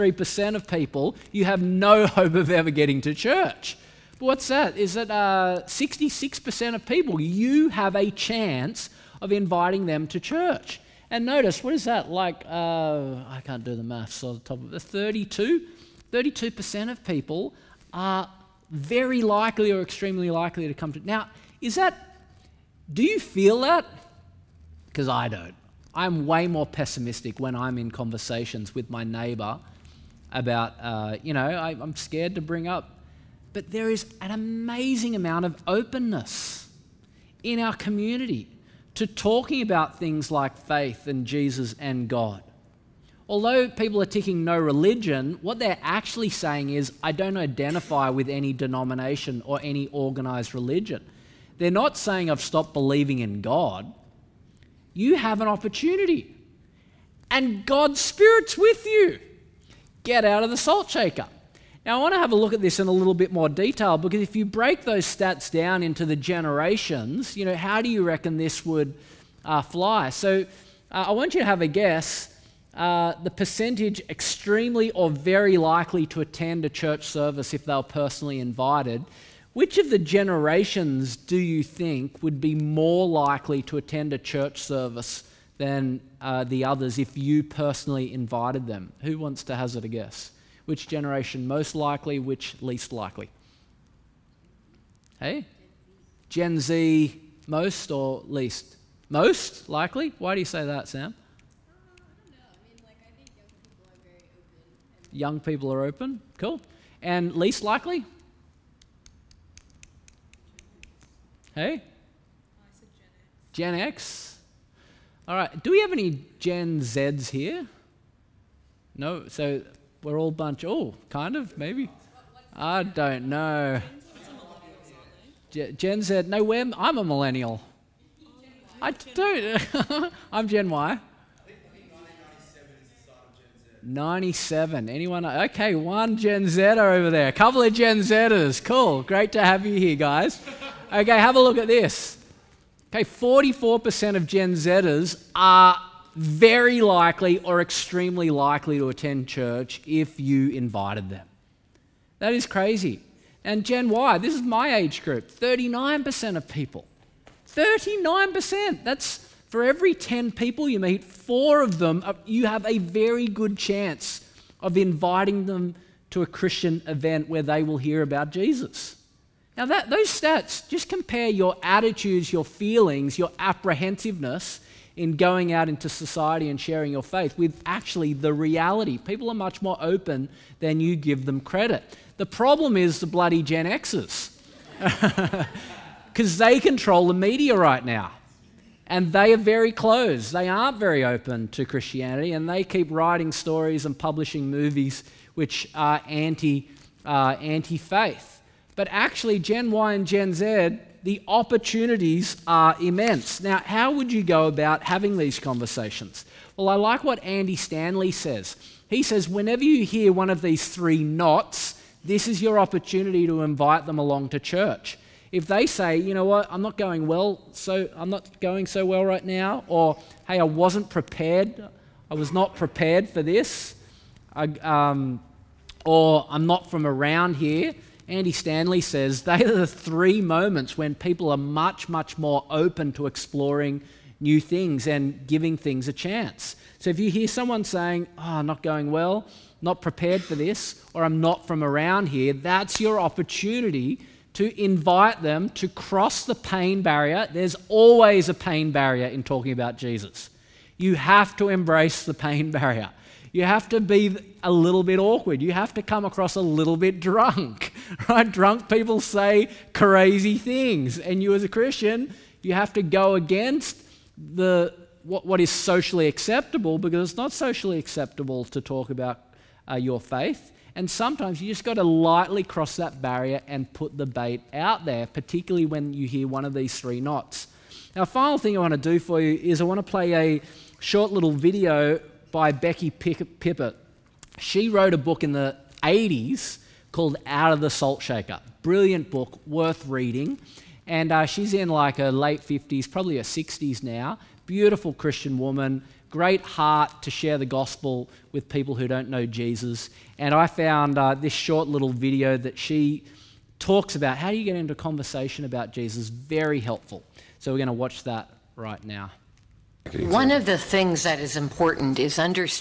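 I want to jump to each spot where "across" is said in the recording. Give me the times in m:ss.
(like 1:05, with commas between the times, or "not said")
4:16.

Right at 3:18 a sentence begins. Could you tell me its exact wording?
But actually, Gen Y and Gen Z, the opportunities are immense.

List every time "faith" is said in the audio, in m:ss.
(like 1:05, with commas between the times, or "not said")
0:40, 2:57, 3:17, 4:29.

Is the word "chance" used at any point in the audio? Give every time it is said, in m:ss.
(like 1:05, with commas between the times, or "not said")
0:08, 2:43, 3:55.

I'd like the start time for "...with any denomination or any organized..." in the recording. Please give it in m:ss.
0:48.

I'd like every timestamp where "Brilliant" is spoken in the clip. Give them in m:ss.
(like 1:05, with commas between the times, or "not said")
4:48.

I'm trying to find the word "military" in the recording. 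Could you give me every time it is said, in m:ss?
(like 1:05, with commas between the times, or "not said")
not said.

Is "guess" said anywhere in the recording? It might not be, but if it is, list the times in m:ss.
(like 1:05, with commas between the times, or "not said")
1:11, 1:29.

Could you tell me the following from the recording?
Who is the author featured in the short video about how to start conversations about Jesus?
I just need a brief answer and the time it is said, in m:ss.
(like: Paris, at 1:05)
Becky Pippert, at 4:42.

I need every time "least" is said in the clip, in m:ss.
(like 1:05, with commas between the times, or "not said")
1:32, 1:38, 1:47.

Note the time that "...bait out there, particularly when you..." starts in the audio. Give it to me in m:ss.
4:34.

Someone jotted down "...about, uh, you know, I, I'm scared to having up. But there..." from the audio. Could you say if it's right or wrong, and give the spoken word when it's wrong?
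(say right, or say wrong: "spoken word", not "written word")
wrong: "bring", not "having".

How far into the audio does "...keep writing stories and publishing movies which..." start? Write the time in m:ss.
3:12.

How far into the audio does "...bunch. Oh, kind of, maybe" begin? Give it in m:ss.
2:00.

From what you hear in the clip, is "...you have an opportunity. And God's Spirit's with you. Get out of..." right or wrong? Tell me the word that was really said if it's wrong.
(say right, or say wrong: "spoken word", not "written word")
right.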